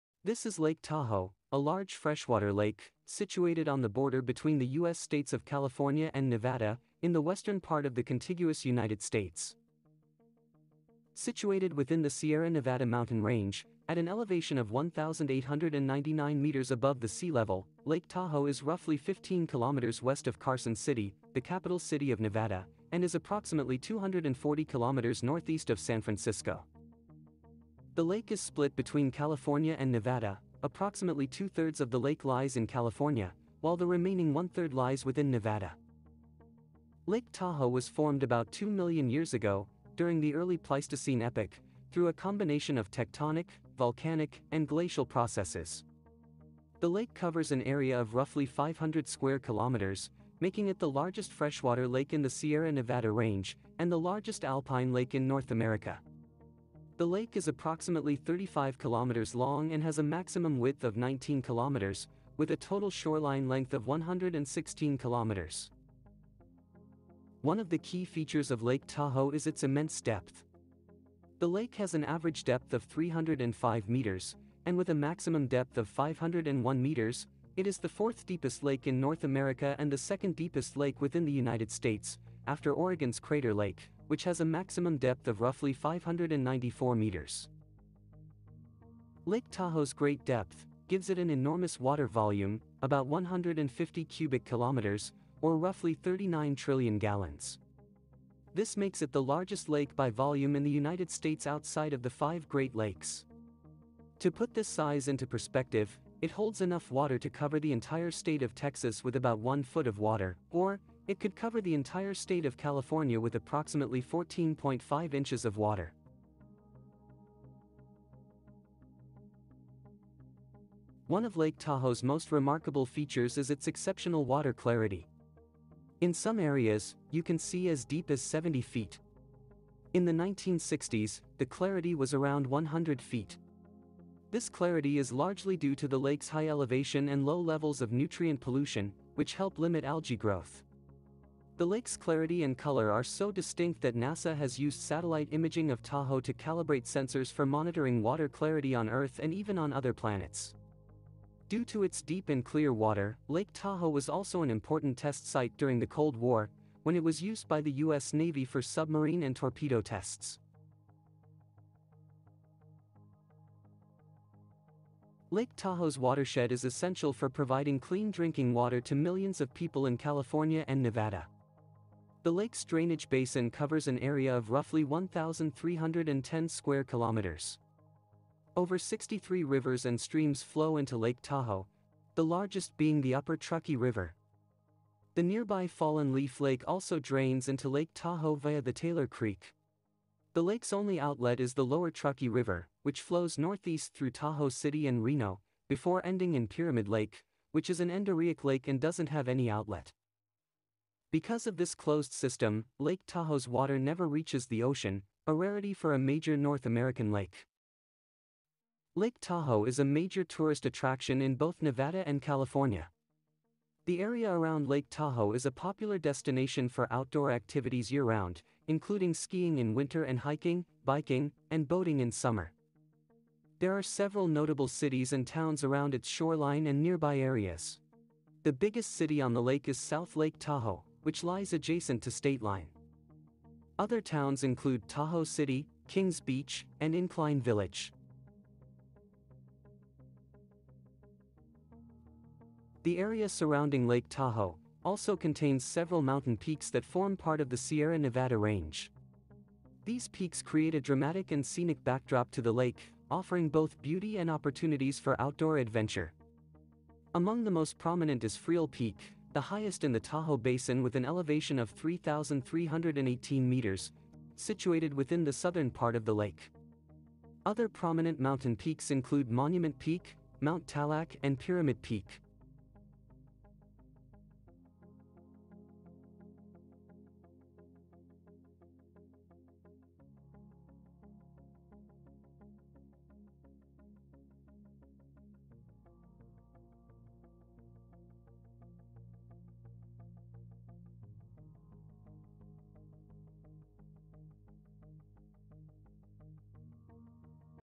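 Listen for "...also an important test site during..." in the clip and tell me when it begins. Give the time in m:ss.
2:34.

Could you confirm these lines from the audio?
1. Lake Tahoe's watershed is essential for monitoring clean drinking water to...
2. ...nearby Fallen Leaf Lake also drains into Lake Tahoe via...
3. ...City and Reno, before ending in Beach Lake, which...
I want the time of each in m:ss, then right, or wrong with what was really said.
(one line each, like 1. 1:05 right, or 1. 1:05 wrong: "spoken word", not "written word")
1. 2:45 wrong: "providing", not "monitoring"
2. 3:05 right
3. 3:14 wrong: "Pyramid", not "Beach".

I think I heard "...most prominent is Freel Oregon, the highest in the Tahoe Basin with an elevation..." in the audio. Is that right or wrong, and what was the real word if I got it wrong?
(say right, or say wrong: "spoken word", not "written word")
wrong: "Peak", not "Oregon".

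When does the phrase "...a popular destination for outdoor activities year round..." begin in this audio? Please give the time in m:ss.
3:35.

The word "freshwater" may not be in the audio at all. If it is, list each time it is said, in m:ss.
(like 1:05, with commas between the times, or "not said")
0:01, 0:51.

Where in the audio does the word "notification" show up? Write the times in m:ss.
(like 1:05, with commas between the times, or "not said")
not said.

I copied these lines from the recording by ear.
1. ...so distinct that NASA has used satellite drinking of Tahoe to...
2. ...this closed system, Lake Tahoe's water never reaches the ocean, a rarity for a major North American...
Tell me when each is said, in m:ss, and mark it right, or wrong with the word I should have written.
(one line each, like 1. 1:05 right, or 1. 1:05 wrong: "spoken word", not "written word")
1. 2:23 wrong: "imaging", not "drinking"
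2. 3:21 right.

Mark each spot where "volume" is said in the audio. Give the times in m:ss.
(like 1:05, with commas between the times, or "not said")
1:32, 1:40.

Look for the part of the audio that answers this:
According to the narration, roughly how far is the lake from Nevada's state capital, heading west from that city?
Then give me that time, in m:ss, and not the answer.
0:18.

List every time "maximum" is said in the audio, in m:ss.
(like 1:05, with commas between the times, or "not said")
1:00, 1:15, 1:24.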